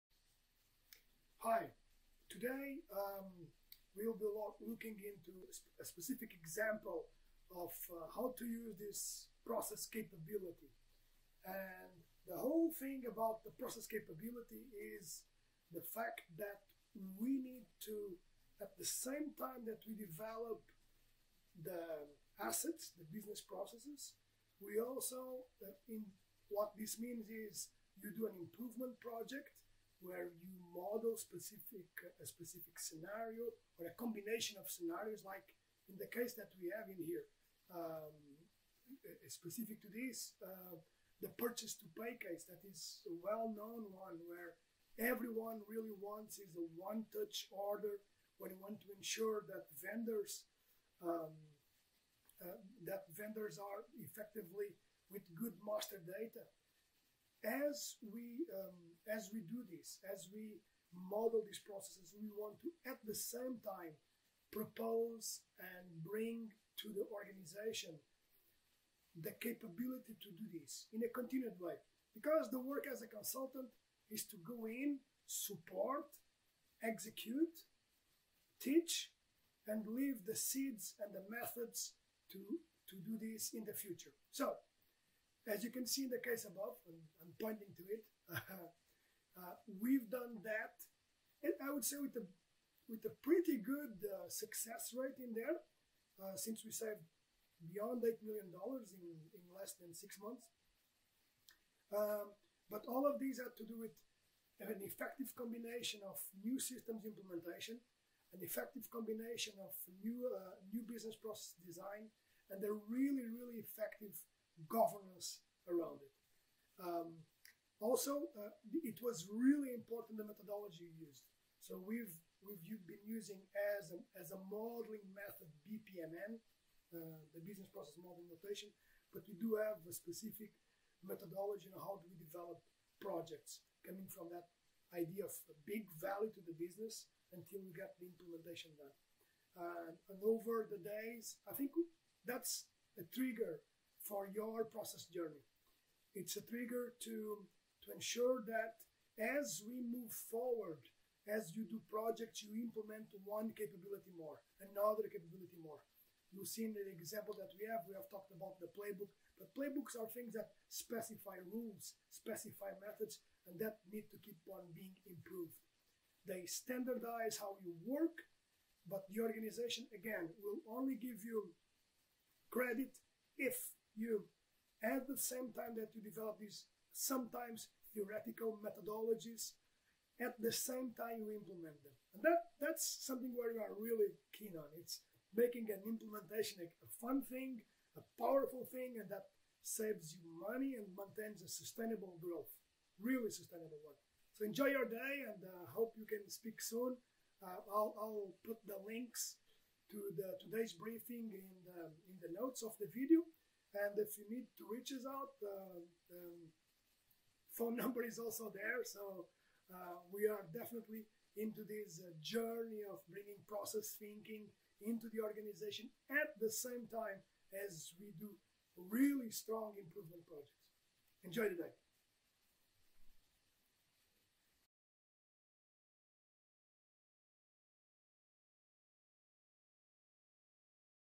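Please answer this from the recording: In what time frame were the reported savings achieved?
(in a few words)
Less than six months.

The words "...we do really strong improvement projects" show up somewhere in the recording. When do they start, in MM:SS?
03:37.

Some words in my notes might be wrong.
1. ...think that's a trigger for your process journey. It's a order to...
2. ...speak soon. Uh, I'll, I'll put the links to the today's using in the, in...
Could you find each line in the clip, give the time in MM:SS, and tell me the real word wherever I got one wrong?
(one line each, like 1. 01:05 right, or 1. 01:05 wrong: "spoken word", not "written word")
1. 02:21 wrong: "trigger", not "order"
2. 03:16 wrong: "briefing", not "using".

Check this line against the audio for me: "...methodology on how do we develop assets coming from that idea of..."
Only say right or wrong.
wrong.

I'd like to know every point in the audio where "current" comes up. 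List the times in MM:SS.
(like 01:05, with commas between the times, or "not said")
not said.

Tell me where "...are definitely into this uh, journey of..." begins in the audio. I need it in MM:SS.
03:30.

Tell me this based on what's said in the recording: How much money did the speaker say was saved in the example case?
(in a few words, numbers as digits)
Beyond $8 million.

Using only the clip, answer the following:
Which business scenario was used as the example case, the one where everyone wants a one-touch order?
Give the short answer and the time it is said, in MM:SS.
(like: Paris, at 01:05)
Purchase to pay, at 00:41.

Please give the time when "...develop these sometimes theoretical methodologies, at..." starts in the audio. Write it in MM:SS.
02:56.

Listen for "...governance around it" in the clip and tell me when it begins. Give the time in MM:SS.
01:54.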